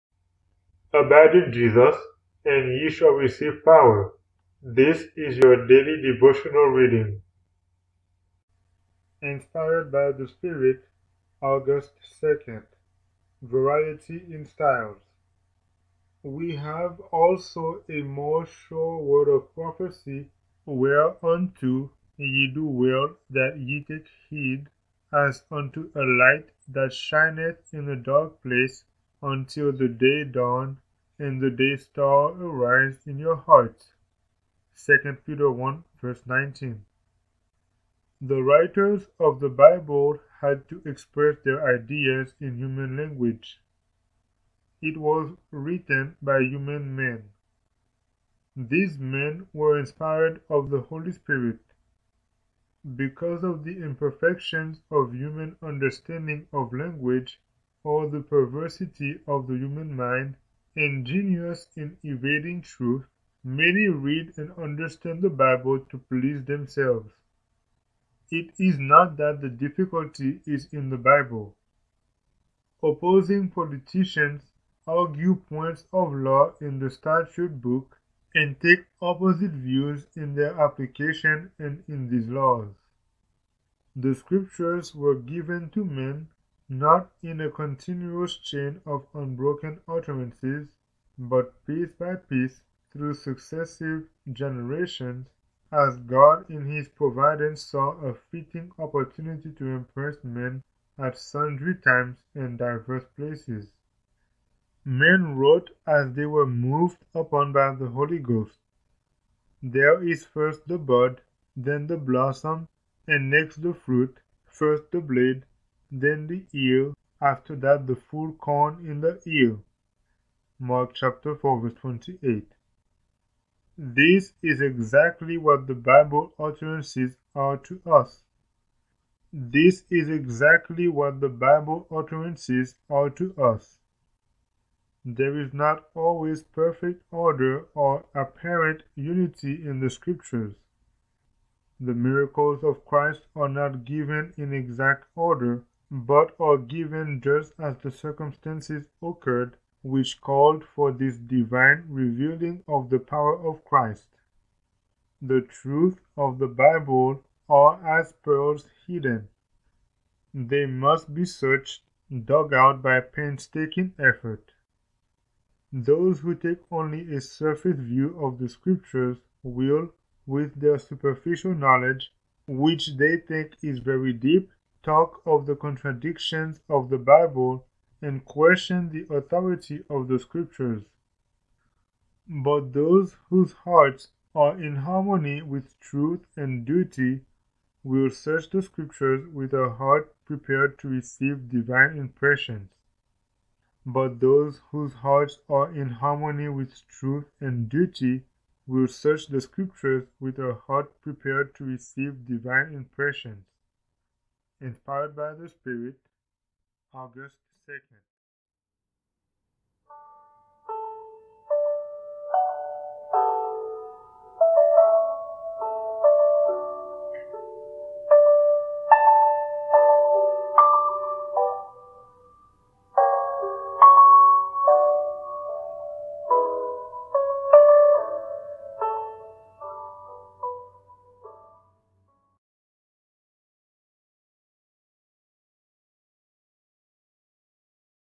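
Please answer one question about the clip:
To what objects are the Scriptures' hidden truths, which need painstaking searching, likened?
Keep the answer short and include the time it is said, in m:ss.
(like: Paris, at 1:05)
Pearls, at 2:38.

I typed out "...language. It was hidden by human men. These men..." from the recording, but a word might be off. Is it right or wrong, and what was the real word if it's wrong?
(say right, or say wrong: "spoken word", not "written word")
wrong: "written", not "hidden".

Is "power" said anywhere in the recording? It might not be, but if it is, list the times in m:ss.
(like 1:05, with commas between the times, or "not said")
0:03, 2:32.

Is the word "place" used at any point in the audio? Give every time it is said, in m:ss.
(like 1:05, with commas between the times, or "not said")
0:28, 1:43.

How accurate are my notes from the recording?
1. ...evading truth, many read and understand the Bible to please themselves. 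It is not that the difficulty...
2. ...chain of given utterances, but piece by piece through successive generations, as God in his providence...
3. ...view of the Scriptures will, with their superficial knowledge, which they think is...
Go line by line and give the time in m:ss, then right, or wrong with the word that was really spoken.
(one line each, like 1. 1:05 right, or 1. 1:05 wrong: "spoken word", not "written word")
1. 1:02 right
2. 1:28 wrong: "unbroken", not "given"
3. 2:47 right.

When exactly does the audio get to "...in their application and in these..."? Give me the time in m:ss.
1:20.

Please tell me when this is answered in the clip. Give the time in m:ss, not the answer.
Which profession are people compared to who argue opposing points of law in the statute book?
1:13.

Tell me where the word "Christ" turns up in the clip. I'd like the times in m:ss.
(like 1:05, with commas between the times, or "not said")
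2:22, 2:33.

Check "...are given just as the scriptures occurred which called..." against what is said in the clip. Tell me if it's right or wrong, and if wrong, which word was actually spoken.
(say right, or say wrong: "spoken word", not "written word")
wrong: "circumstances", not "scriptures".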